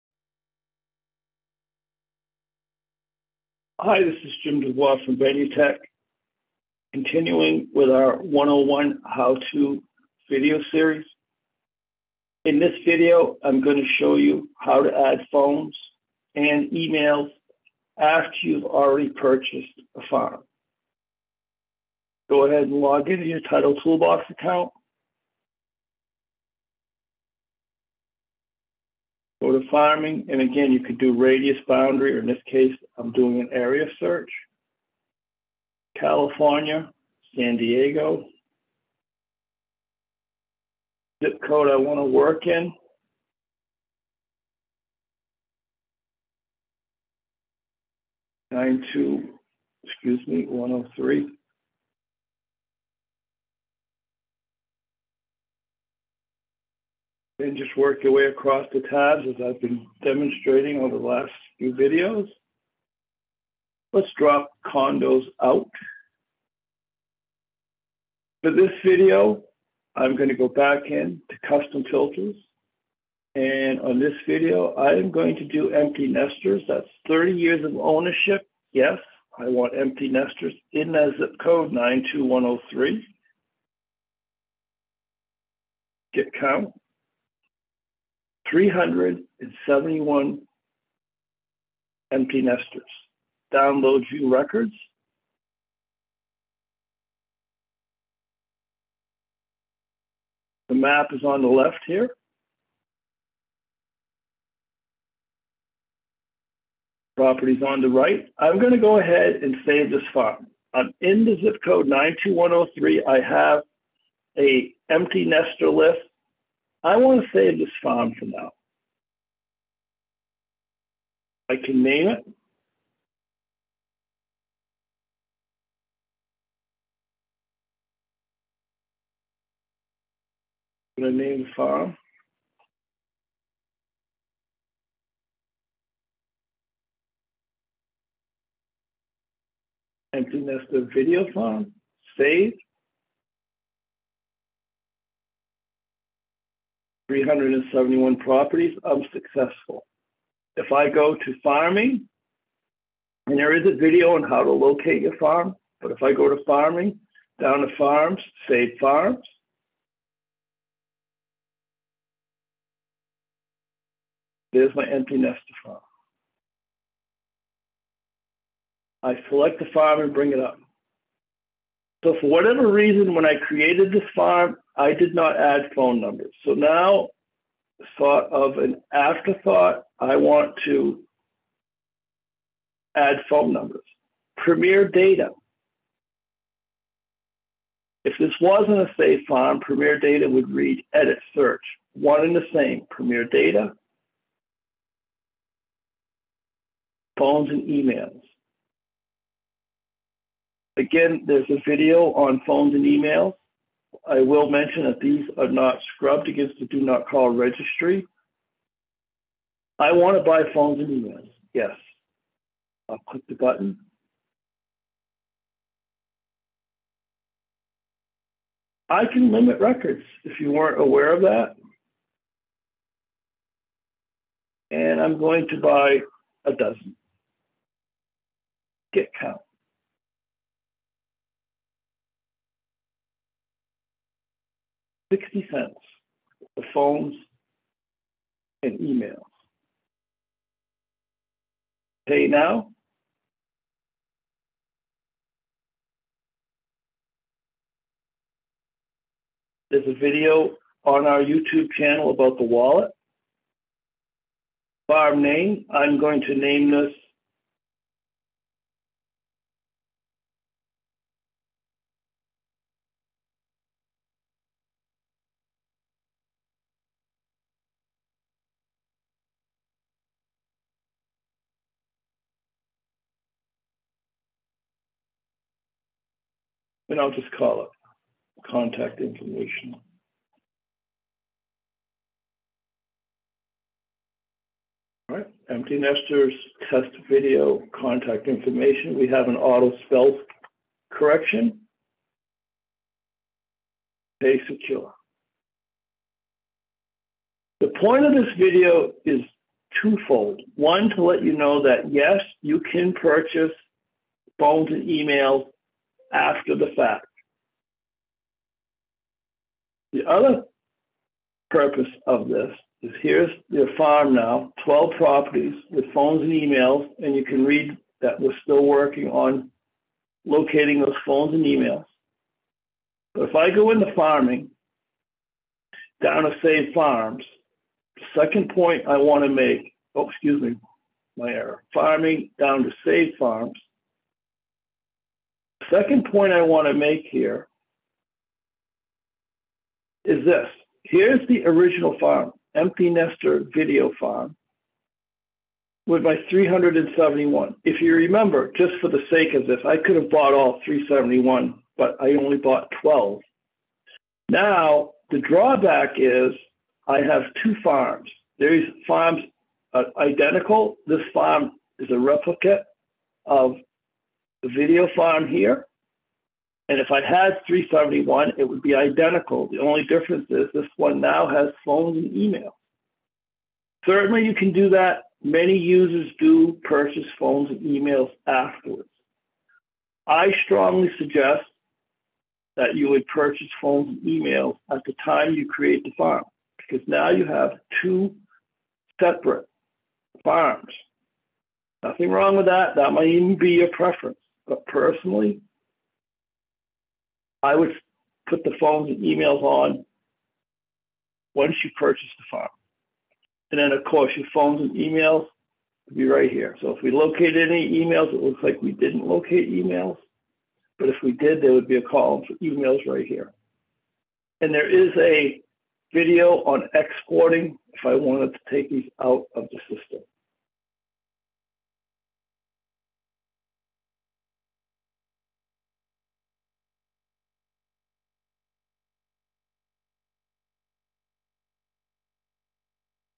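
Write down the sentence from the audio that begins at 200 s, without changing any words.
Again, there's a video on phones and emails.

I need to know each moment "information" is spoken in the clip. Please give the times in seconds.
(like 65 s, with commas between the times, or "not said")
278 s, 288 s.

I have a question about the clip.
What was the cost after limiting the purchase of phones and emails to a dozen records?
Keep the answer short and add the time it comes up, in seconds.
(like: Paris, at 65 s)
60 cents, at 235 s.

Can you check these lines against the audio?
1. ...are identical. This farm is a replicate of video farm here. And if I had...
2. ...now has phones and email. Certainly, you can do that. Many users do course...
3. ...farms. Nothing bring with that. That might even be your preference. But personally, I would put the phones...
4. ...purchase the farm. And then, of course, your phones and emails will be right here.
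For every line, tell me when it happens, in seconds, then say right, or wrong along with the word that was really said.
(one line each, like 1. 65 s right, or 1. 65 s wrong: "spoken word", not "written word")
1. 359 s right
2. 371 s wrong: "purchase", not "course"
3. 390 s wrong: "wrong", not "bring"
4. 401 s right.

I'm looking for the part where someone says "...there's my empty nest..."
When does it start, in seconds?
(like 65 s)
164 s.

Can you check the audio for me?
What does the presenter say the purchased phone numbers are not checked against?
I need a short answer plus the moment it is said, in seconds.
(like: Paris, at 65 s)
the do not call registry, at 206 s.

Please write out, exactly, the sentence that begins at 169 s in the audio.
I select the farm and bring it up.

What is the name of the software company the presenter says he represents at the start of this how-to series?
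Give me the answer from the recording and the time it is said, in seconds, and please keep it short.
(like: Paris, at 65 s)
Benutech, at 5 s.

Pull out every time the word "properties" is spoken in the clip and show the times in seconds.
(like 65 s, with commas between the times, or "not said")
107 s, 148 s, 314 s.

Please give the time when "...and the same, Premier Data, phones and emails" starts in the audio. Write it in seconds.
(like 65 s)
192 s.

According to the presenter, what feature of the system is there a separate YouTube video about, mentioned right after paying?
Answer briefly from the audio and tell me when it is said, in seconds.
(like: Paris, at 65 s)
the wallet, at 252 s.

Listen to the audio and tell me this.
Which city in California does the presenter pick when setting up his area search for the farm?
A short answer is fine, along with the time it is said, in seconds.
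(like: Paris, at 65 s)
San Diego, at 37 s.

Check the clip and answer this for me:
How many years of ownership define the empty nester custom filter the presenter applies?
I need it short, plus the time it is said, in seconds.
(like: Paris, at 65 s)
30 years, at 77 s.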